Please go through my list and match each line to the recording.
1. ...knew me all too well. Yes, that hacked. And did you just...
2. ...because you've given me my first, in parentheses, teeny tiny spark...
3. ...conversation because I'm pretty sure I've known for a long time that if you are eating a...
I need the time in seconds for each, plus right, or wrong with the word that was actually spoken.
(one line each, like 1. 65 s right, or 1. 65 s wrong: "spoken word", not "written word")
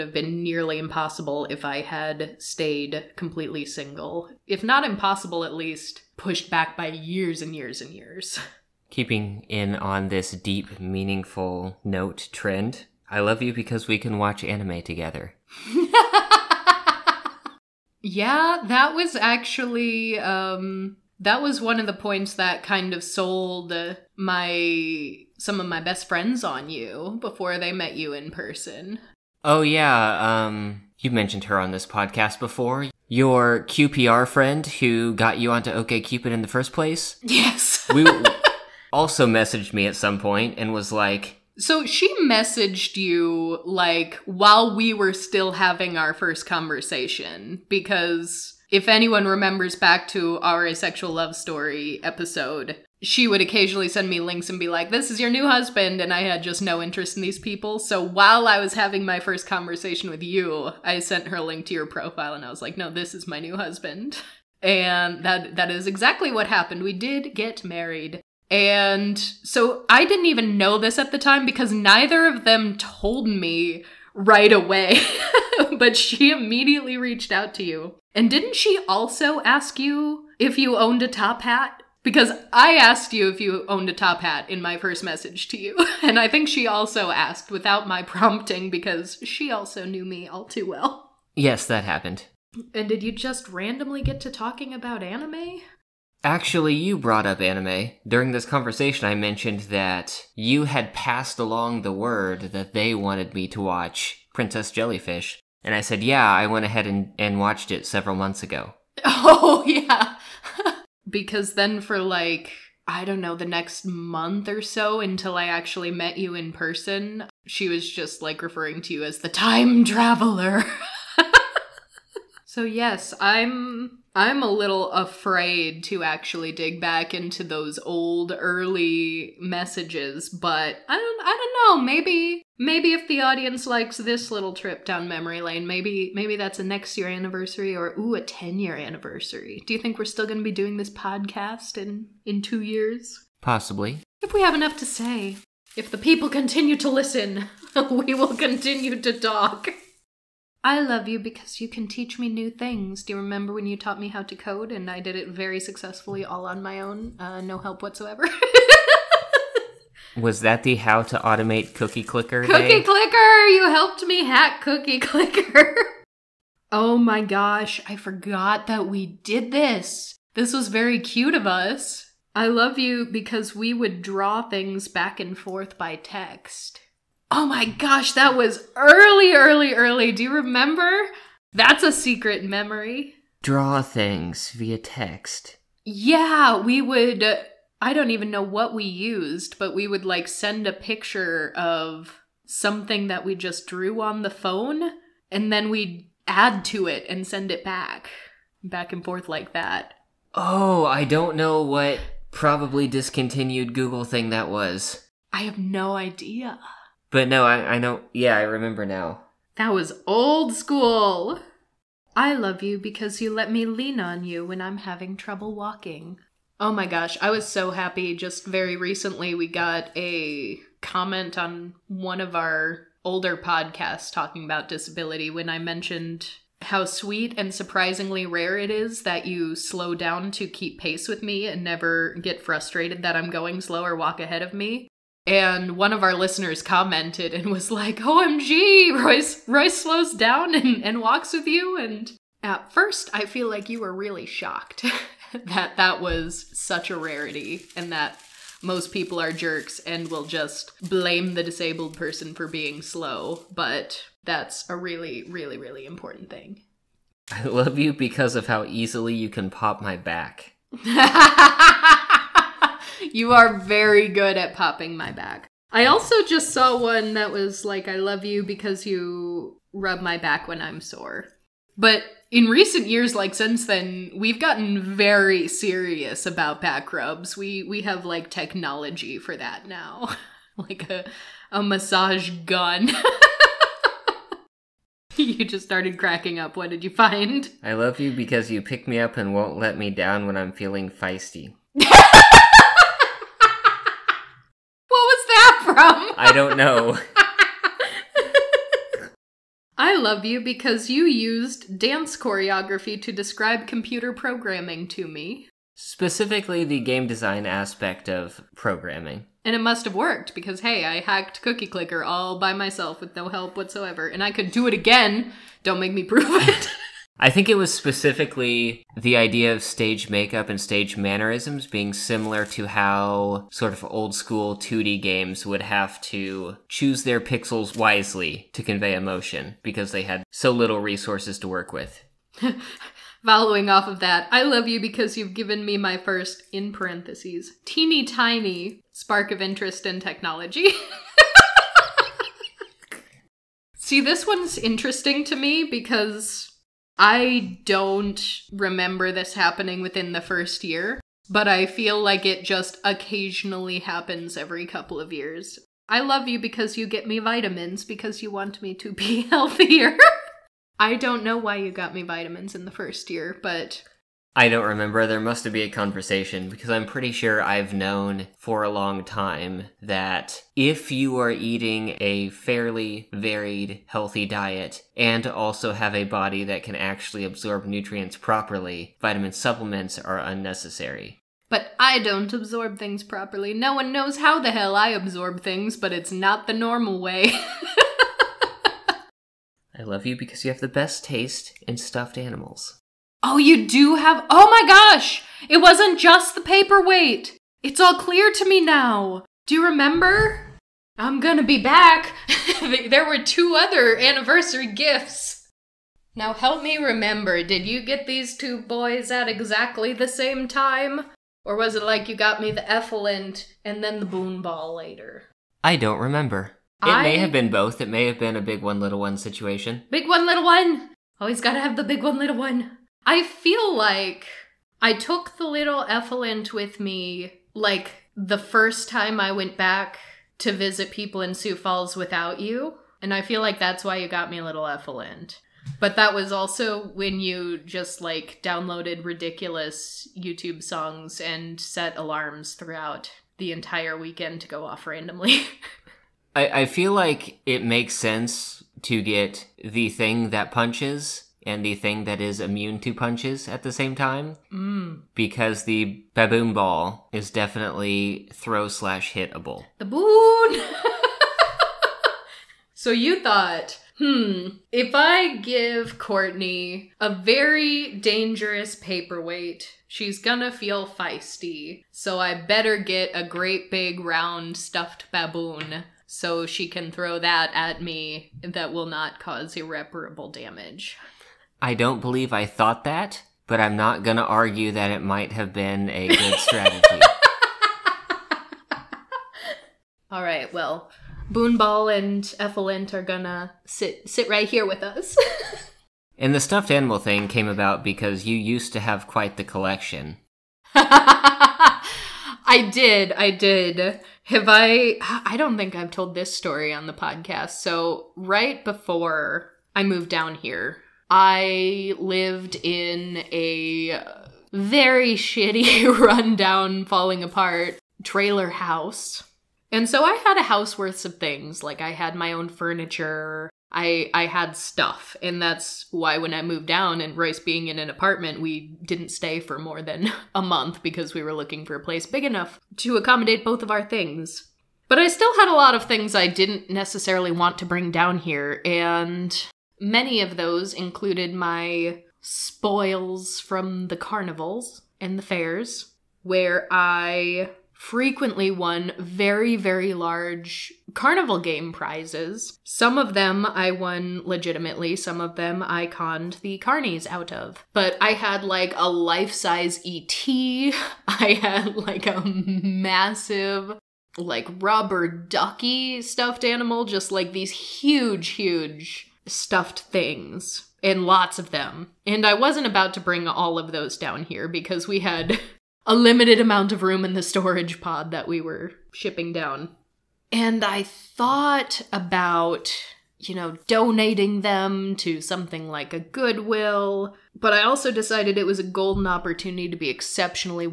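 1. 89 s wrong: "happened", not "hacked"
2. 334 s right
3. 365 s right.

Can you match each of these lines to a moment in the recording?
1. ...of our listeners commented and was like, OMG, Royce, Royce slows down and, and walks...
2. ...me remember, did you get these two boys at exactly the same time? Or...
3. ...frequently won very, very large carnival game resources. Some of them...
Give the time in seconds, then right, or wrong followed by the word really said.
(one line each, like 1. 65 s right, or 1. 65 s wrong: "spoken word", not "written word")
1. 235 s right
2. 406 s right
3. 547 s wrong: "prizes", not "resources".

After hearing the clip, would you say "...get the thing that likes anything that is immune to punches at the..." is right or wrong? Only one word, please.
wrong.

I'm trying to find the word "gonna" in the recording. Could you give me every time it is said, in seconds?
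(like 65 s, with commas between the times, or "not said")
401 s, 470 s, 493 s.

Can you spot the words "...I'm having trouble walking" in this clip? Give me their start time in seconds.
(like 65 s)
214 s.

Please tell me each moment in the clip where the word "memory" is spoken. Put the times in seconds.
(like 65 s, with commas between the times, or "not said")
135 s, 182 s.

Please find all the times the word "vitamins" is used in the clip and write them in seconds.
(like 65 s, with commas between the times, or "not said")
357 s, 362 s, 379 s.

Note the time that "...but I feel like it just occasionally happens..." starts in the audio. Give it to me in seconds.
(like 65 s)
351 s.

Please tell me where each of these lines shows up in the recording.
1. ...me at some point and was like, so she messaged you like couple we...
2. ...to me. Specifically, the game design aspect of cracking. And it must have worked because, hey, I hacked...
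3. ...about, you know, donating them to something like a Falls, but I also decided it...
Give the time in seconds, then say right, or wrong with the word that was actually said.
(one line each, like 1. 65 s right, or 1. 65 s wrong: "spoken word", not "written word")
1. 39 s wrong: "while", not "couple"
2. 304 s wrong: "programming", not "cracking"
3. 581 s wrong: "Goodwill", not "Falls".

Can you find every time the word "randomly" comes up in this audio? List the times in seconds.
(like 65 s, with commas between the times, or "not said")
93 s, 444 s.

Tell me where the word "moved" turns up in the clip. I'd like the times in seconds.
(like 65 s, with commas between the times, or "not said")
509 s, 526 s.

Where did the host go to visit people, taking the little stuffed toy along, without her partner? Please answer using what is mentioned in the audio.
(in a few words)
Sioux Falls.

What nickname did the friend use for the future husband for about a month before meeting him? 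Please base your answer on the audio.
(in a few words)
The time traveler.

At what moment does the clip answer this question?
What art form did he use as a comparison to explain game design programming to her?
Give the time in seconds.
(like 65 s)
301 s.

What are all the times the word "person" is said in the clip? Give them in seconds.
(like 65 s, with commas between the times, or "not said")
28 s, 116 s, 251 s.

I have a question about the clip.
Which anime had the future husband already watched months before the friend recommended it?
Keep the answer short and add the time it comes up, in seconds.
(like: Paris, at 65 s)
Princess Jellyfish, at 104 s.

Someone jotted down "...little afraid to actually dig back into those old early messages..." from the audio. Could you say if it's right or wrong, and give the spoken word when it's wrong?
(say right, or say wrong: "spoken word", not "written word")
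right.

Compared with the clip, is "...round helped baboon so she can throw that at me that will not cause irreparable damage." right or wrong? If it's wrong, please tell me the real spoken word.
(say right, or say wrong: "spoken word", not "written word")
wrong: "stuffed", not "helped".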